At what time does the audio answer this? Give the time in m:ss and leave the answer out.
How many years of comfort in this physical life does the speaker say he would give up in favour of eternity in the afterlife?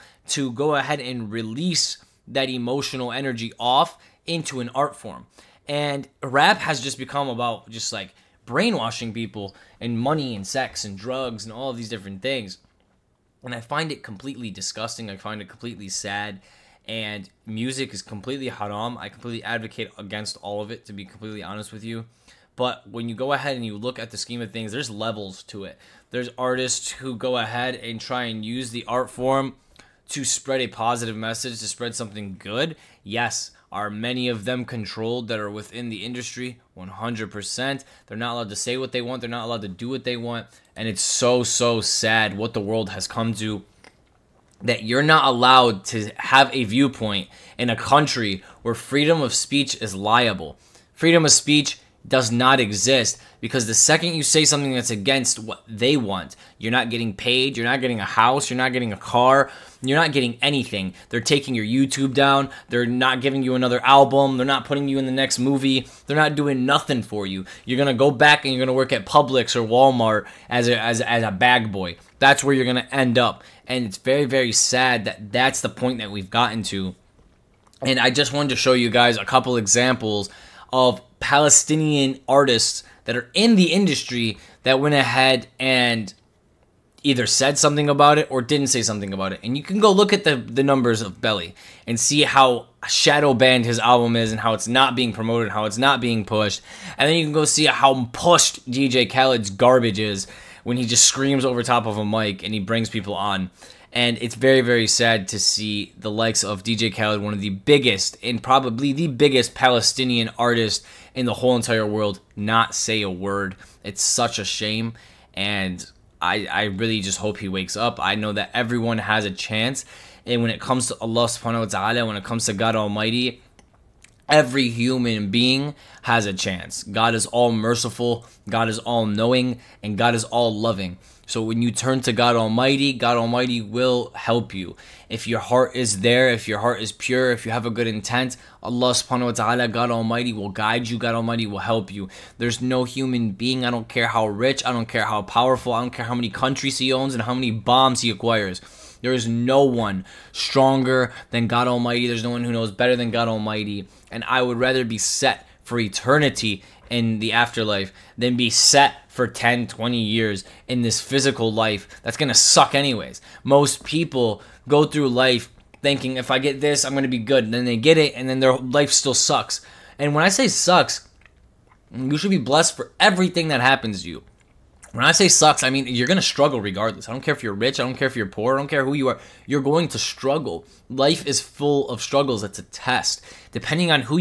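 2:39.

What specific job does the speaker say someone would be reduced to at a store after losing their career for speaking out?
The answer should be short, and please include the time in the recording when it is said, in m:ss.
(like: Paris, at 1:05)
bag boy, at 1:11.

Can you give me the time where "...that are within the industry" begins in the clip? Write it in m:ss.
0:35.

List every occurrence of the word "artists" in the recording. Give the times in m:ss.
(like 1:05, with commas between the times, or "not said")
0:26, 1:22, 1:50.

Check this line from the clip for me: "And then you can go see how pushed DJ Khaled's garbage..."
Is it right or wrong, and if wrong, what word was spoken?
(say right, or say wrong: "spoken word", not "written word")
right.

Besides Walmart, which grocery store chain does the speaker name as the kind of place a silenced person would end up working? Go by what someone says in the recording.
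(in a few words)
Publix.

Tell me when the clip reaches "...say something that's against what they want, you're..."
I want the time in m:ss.
0:54.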